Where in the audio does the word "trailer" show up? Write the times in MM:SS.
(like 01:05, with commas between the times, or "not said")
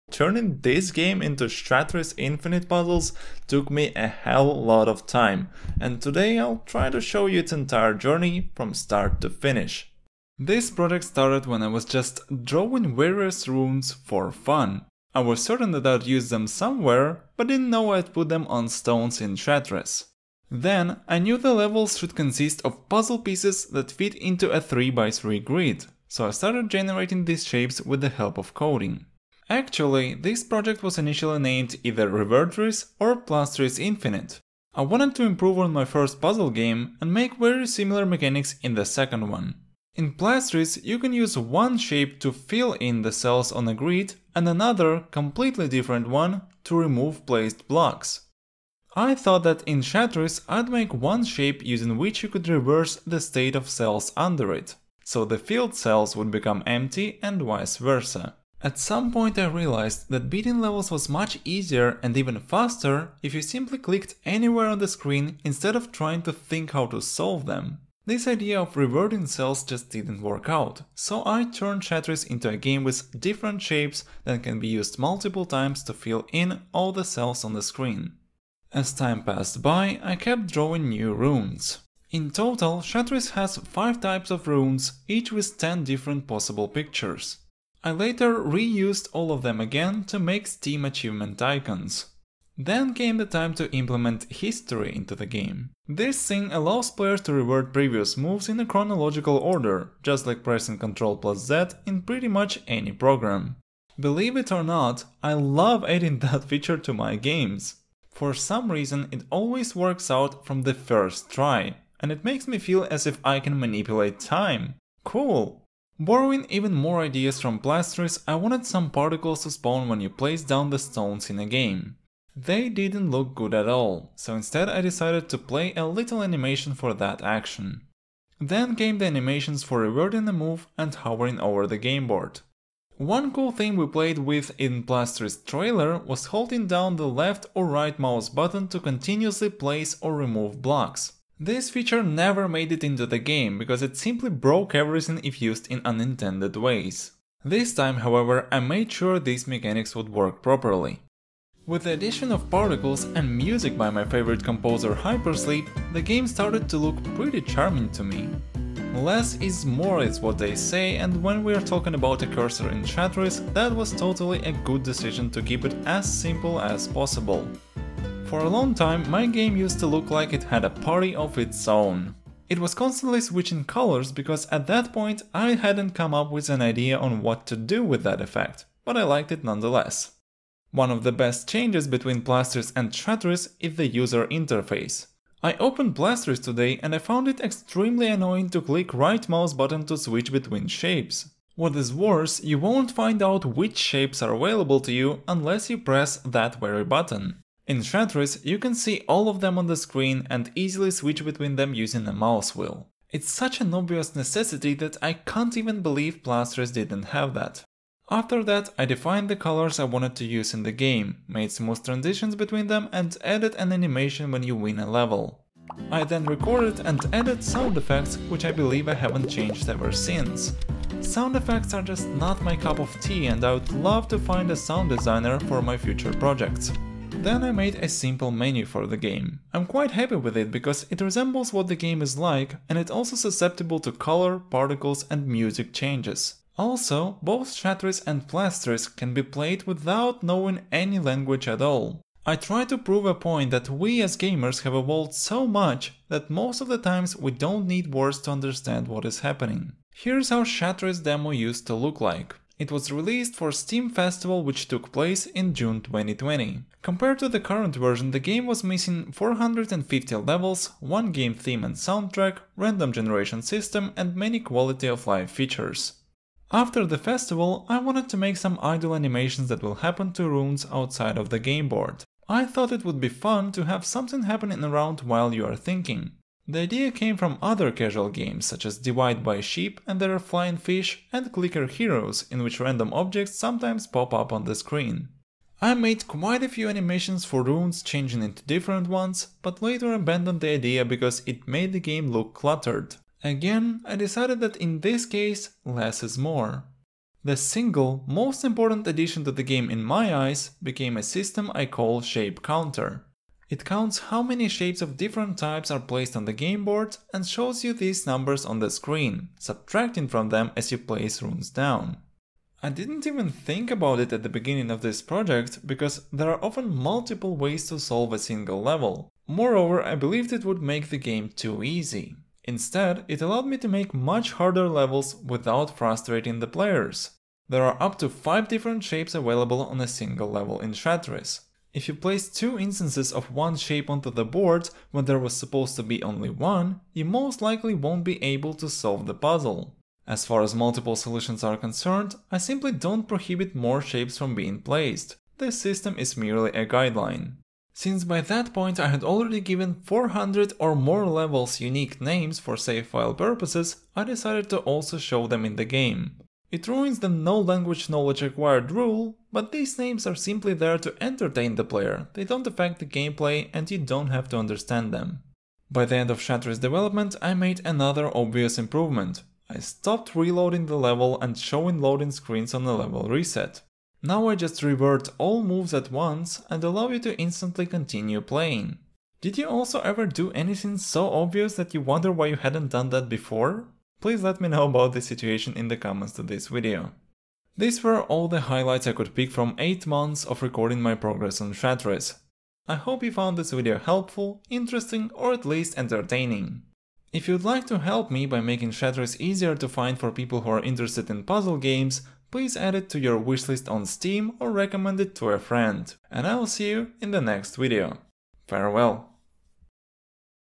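02:15.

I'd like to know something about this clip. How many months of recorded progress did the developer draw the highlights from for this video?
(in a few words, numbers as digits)
8.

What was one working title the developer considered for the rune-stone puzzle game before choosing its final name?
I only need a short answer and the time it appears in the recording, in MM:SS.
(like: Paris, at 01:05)
Revertris, at 00:32.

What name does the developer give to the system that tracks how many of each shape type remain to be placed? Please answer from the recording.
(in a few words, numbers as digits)
Shape Counter.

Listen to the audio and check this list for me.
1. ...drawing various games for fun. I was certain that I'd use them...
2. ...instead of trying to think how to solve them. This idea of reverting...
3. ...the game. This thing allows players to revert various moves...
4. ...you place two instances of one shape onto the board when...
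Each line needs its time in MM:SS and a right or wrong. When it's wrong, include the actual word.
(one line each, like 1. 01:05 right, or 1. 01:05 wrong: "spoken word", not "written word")
1. 00:12 wrong: "runes", not "games"
2. 01:05 right
3. 01:35 wrong: "previous", not "various"
4. 05:31 right.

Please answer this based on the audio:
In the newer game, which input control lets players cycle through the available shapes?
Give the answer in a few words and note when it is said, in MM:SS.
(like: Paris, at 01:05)
mouse wheel, at 03:22.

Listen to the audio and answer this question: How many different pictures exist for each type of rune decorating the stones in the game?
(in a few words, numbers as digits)
10.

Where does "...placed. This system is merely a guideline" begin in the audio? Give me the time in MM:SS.
05:44.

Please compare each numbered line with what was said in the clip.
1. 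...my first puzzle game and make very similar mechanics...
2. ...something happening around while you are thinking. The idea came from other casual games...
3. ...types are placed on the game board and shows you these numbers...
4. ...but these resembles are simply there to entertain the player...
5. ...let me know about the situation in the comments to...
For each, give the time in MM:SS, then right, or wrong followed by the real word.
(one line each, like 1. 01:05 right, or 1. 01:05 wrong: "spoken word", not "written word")
1. 00:35 right
2. 04:33 right
3. 05:05 right
4. 05:59 wrong: "names", not "resembles"
5. 06:24 right.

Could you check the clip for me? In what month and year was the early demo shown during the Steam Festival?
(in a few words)
June 2020.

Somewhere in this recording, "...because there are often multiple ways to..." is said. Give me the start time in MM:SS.
05:15.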